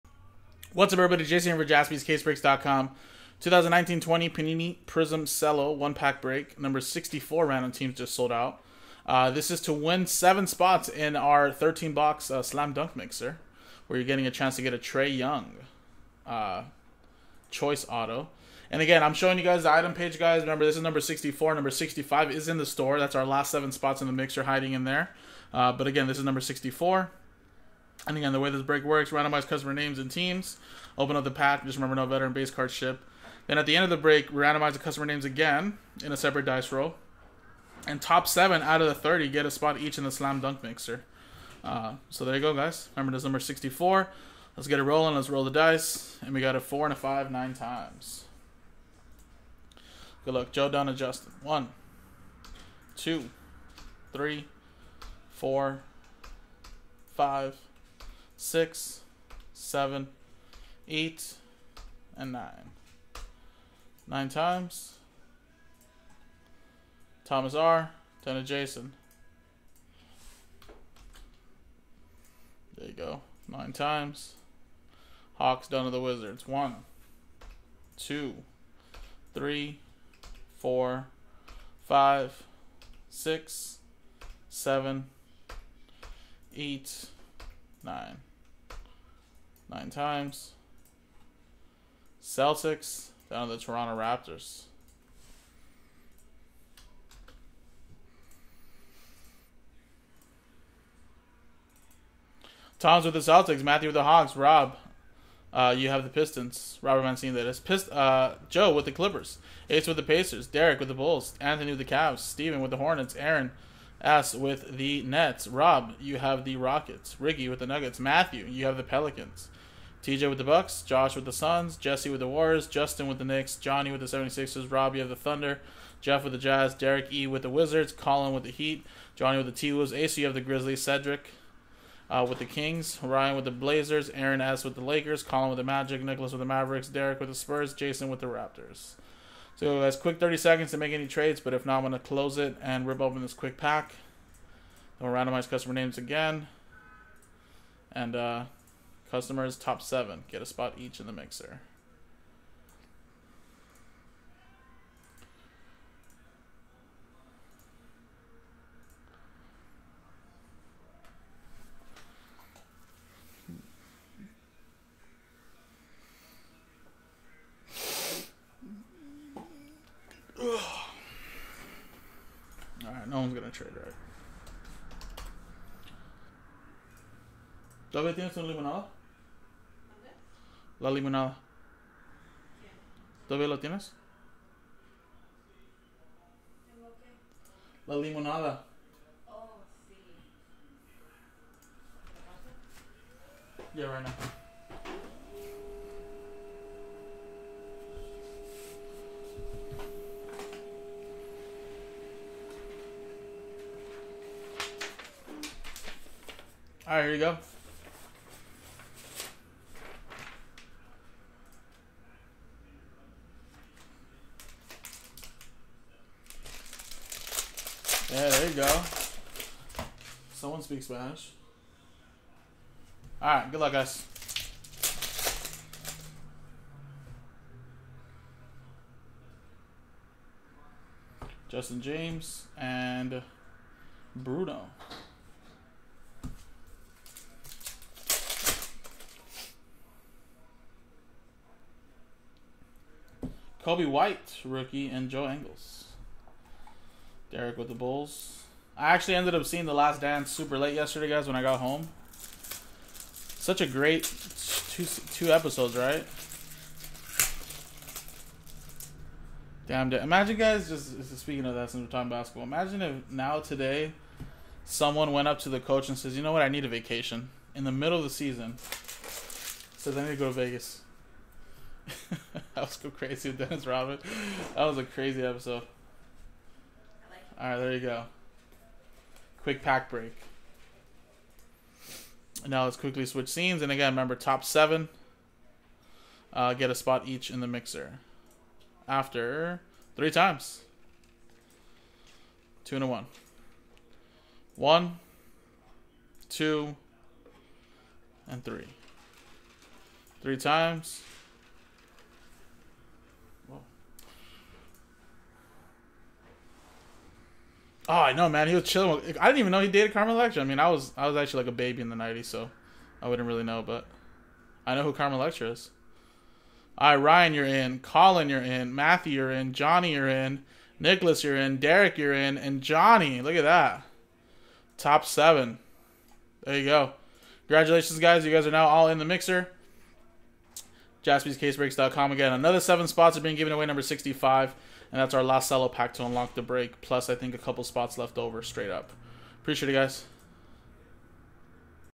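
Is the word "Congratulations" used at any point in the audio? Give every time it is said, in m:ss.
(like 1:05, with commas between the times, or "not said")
5:27.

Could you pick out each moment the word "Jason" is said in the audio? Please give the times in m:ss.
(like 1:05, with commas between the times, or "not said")
0:01, 1:08, 2:17.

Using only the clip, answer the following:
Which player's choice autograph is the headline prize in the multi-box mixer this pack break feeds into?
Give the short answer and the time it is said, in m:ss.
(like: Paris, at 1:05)
Trae Young, at 0:14.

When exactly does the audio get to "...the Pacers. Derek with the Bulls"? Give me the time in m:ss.
1:49.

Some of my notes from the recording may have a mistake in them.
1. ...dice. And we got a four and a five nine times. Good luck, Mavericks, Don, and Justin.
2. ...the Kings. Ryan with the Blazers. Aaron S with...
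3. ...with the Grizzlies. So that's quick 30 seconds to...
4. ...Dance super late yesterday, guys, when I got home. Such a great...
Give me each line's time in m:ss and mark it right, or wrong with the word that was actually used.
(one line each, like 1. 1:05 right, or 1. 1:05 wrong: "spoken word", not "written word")
1. 0:45 wrong: "Joe", not "Mavericks"
2. 2:12 right
3. 2:18 wrong: "Raptors", not "Grizzlies"
4. 4:10 right.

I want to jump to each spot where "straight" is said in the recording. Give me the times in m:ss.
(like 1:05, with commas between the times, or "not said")
5:38.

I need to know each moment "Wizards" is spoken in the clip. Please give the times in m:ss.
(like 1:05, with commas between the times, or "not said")
1:16, 2:07.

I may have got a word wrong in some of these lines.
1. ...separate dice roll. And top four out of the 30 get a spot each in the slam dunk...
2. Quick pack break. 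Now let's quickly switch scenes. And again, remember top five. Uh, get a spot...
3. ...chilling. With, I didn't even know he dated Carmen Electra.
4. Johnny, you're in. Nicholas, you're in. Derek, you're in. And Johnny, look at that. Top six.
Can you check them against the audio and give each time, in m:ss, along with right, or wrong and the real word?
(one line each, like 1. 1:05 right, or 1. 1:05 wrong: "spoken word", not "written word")
1. 0:36 wrong: "seven", not "four"
2. 4:39 wrong: "seven", not "five"
3. 5:08 right
4. 5:19 wrong: "seven", not "six".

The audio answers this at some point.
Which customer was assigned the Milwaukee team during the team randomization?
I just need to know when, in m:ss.
2:00.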